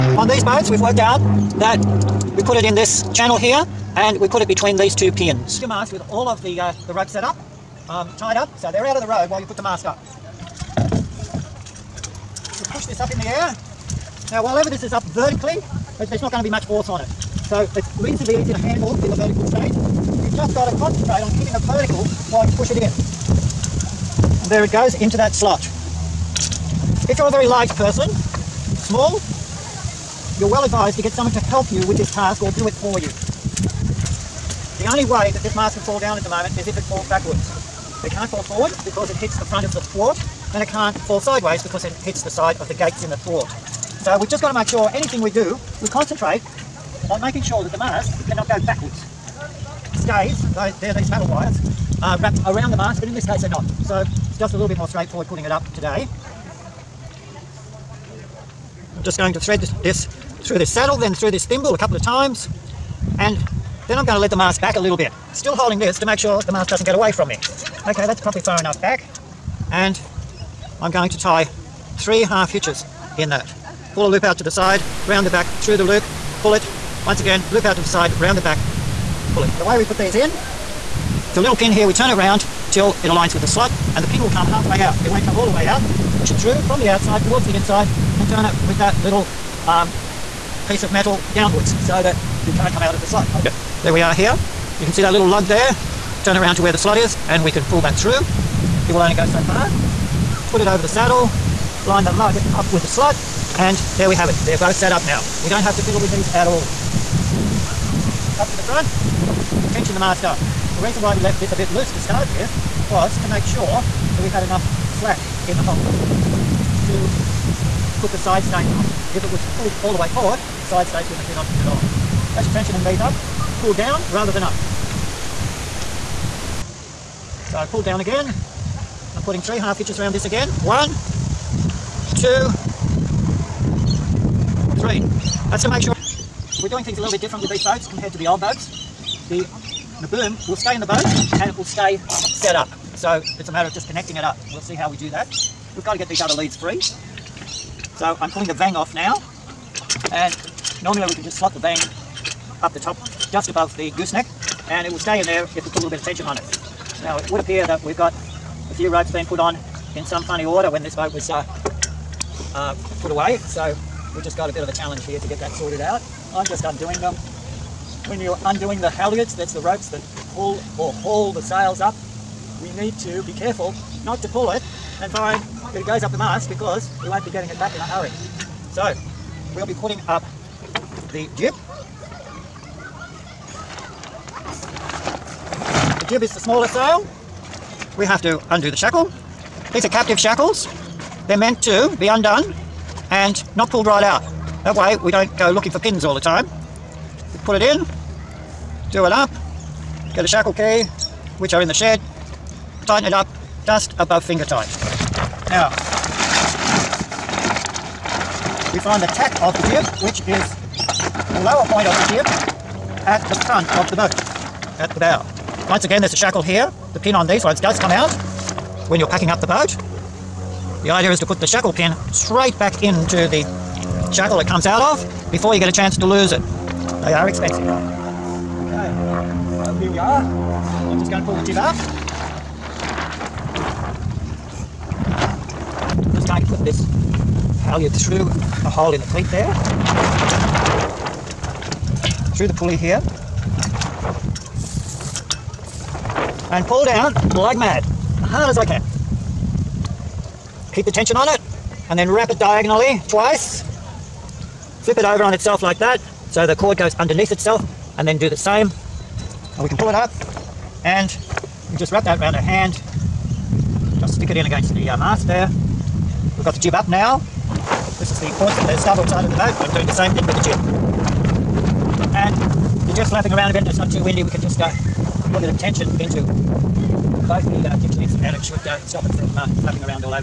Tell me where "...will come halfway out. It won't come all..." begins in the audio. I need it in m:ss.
1:24.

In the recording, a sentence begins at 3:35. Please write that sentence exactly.
Once again, there's a shackle here.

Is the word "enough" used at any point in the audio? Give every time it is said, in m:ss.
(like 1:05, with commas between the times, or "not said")
1:08, 1:54.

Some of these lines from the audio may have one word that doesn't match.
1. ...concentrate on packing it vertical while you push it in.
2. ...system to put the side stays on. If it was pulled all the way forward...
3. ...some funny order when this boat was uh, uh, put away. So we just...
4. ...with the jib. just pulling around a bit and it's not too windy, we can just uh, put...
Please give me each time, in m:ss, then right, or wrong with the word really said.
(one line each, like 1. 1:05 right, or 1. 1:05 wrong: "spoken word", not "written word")
1. 0:20 wrong: "keeping", not "packing"
2. 1:55 right
3. 2:40 right
4. 4:30 wrong: "flapping", not "pulling".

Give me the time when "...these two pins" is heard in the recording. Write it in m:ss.
0:04.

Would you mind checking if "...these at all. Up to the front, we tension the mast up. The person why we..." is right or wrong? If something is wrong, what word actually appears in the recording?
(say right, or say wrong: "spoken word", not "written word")
wrong: "reason", not "person".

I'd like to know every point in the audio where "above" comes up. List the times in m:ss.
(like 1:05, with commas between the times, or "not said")
2:33, 3:23.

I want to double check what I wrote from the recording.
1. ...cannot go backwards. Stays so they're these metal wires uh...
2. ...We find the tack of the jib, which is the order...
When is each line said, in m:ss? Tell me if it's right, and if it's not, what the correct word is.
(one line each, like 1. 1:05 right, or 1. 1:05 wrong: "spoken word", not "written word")
1. 0:48 right
2. 3:28 wrong: "lower", not "order".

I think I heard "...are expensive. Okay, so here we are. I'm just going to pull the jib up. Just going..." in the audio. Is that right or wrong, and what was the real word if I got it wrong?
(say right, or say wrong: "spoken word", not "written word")
right.